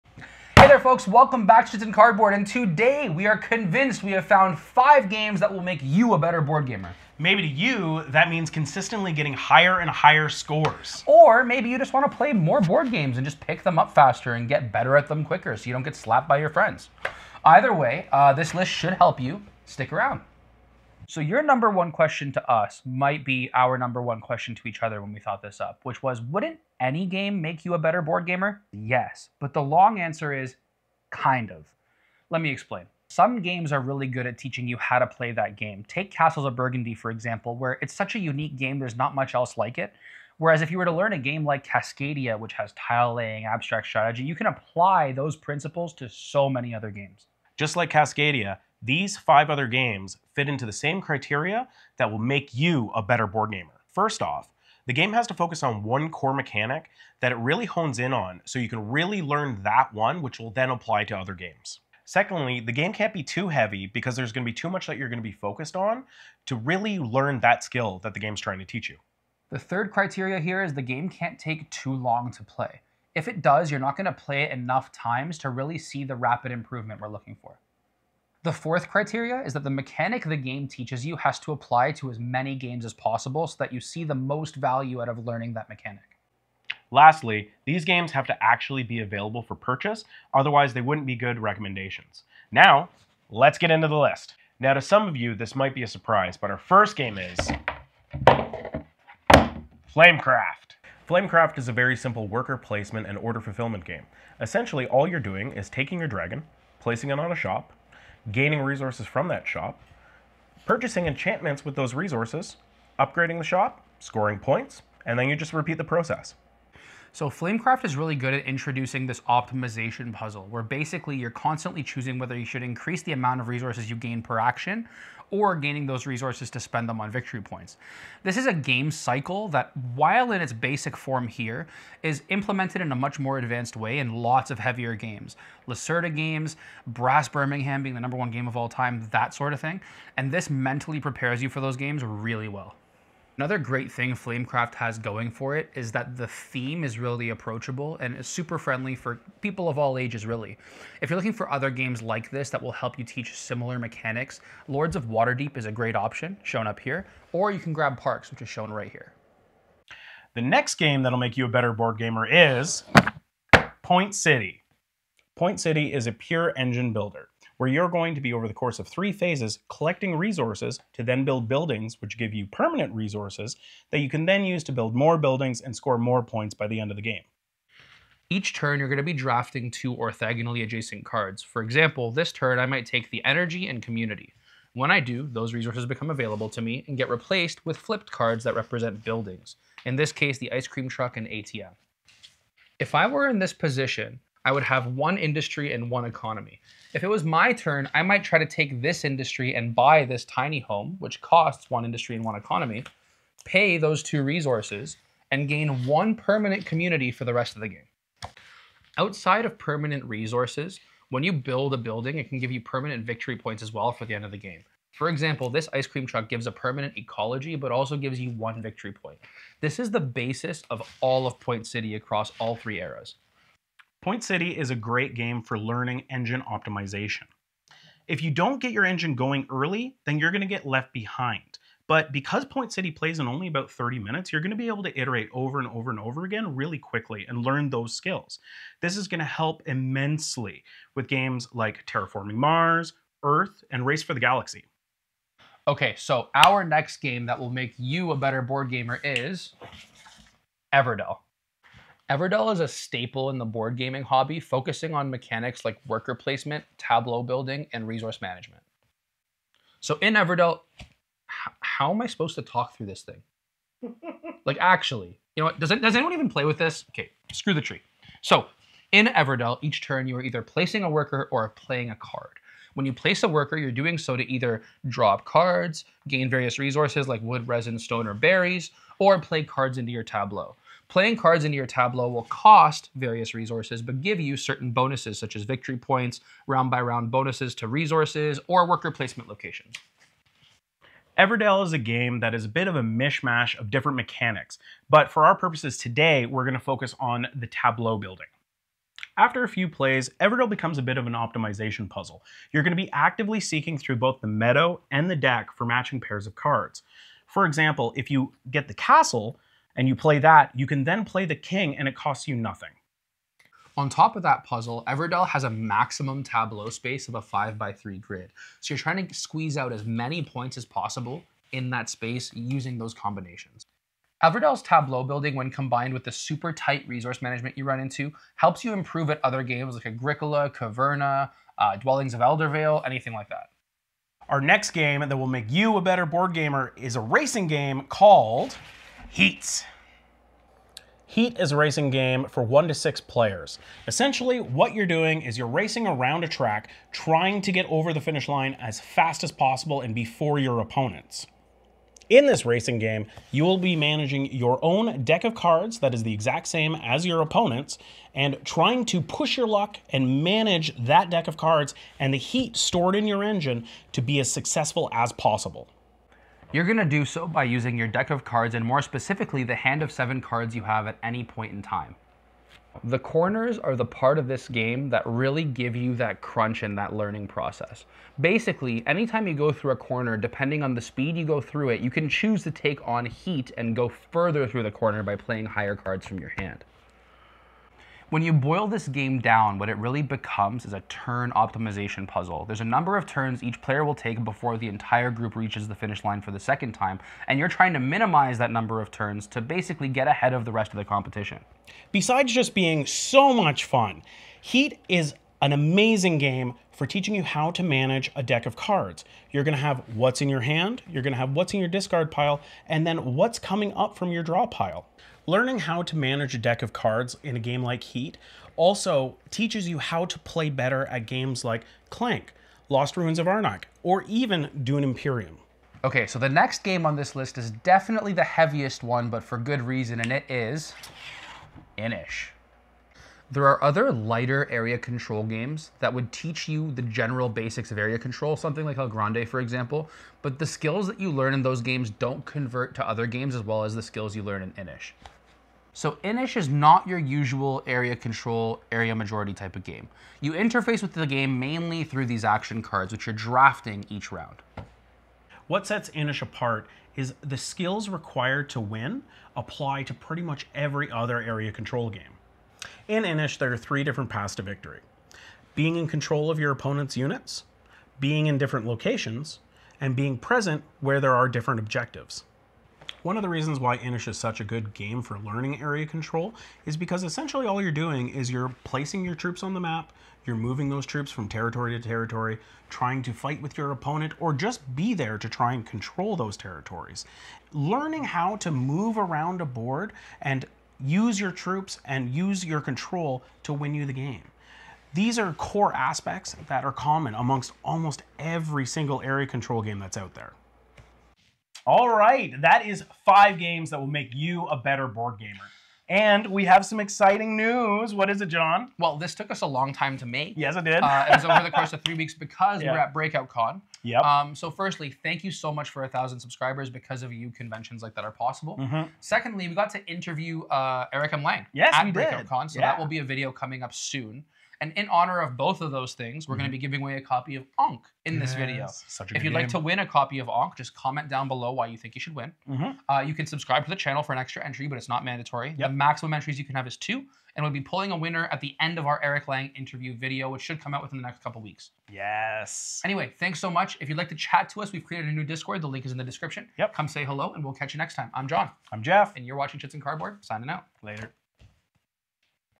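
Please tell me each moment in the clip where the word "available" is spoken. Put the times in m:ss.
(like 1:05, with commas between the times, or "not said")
1:29, 3:06.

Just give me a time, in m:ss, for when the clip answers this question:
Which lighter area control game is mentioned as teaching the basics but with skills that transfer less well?
7:18.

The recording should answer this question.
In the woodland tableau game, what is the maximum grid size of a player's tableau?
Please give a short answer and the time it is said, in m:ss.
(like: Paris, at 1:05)
5 by 3, at 5:17.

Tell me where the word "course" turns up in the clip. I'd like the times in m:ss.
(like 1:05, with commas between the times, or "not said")
2:48, 8:31.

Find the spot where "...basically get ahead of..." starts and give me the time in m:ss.
6:39.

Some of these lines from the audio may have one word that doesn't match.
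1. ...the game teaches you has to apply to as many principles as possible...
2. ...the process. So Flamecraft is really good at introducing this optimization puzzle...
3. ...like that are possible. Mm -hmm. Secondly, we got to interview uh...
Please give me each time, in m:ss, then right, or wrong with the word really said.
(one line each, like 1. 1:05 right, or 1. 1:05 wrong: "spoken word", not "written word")
1. 1:20 wrong: "games", not "principles"
2. 1:55 right
3. 8:37 right.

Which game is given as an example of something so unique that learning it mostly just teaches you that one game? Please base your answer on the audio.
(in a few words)
Castles of Burgundy.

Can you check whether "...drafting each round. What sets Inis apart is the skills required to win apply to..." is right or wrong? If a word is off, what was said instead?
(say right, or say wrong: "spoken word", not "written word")
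right.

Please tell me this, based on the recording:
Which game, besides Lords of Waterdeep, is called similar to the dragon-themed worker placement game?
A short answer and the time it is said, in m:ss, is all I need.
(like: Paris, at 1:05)
Parks, at 2:37.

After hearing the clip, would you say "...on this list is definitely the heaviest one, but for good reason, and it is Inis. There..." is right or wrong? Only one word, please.
right.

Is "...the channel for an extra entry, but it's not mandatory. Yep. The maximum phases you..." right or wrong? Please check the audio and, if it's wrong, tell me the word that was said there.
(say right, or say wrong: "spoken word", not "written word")
wrong: "entries", not "phases".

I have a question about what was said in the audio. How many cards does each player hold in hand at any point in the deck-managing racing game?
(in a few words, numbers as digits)
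7.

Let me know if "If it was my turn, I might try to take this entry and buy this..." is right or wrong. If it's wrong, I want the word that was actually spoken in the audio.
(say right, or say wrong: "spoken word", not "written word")
wrong: "industry", not "entry".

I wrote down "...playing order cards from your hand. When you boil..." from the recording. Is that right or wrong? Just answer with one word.
wrong.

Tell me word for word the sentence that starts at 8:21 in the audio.
All right, that is five games that will make you a better board gamer.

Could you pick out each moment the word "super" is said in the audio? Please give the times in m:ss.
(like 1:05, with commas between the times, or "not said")
2:28, 5:26.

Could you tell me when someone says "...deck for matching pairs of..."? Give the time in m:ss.
5:05.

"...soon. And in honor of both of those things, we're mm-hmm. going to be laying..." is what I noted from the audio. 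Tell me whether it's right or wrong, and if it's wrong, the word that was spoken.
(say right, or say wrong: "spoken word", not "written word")
wrong: "giving", not "laying".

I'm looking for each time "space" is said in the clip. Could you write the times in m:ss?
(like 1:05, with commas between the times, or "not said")
5:16, 5:21.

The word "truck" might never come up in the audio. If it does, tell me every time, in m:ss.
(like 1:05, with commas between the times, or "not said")
3:10, 3:36.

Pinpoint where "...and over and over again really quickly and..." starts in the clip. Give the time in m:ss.
3:55.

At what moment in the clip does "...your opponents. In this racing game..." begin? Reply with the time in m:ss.
5:50.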